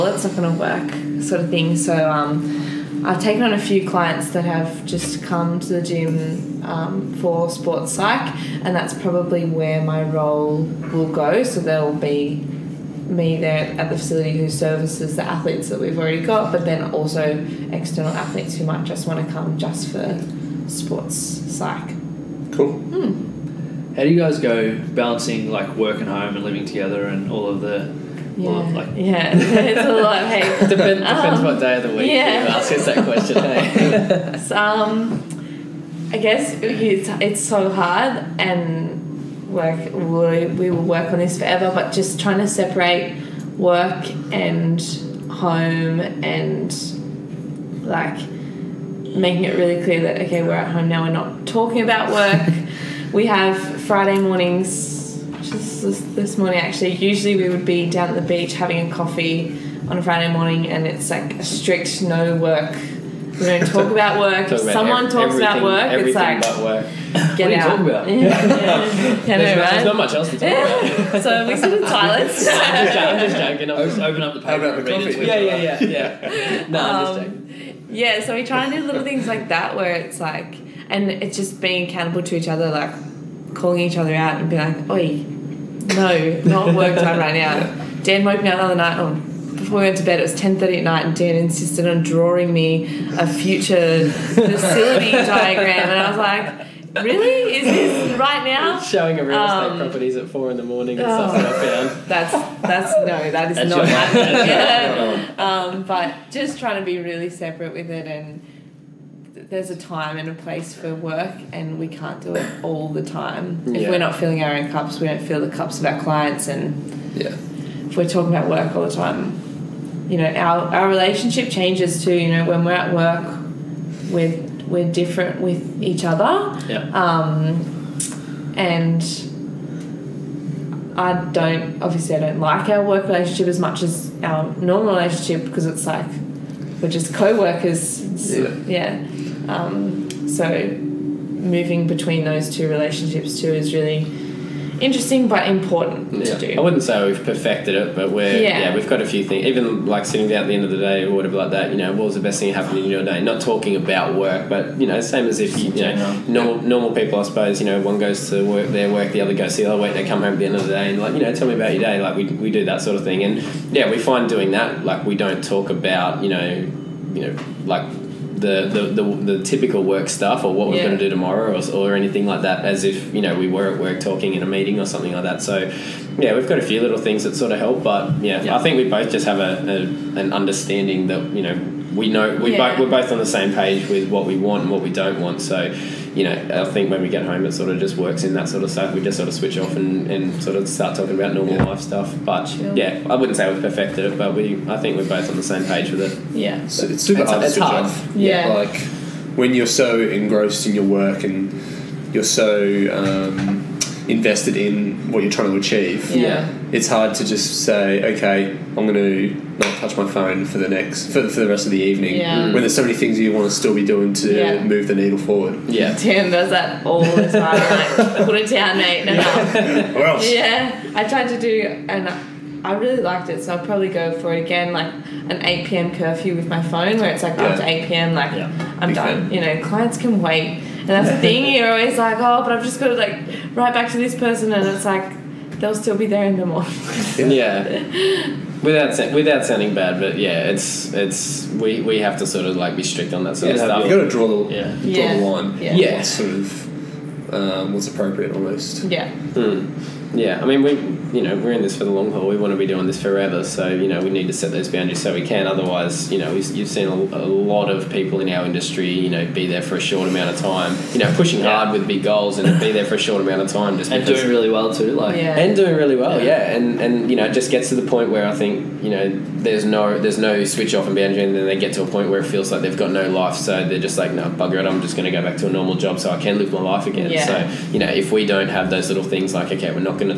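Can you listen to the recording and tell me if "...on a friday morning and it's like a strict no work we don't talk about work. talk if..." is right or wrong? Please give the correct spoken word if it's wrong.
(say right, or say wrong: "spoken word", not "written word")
right.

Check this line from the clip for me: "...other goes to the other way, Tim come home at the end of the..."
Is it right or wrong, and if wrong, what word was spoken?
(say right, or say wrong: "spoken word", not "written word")
wrong: "They", not "Tim".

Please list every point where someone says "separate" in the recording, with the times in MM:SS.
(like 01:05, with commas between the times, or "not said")
00:42, 01:47.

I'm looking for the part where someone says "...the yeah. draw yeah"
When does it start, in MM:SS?
04:04.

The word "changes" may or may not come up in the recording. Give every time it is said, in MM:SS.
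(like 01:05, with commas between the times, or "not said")
02:01.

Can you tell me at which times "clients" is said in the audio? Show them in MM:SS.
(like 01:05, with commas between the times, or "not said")
00:03, 01:56, 03:49.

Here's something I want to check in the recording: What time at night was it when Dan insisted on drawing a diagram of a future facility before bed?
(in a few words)
10.30.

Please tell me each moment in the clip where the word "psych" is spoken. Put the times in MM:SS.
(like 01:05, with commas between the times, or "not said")
00:07, 00:21.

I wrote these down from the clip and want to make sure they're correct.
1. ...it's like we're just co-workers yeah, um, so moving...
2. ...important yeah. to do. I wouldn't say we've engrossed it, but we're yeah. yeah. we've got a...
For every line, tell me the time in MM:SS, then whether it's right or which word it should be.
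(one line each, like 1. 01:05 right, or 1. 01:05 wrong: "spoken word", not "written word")
1. 02:15 right
2. 02:25 wrong: "perfected", not "engrossed".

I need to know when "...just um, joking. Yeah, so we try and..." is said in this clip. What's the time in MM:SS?
01:17.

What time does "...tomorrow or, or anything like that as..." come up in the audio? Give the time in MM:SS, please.
02:51.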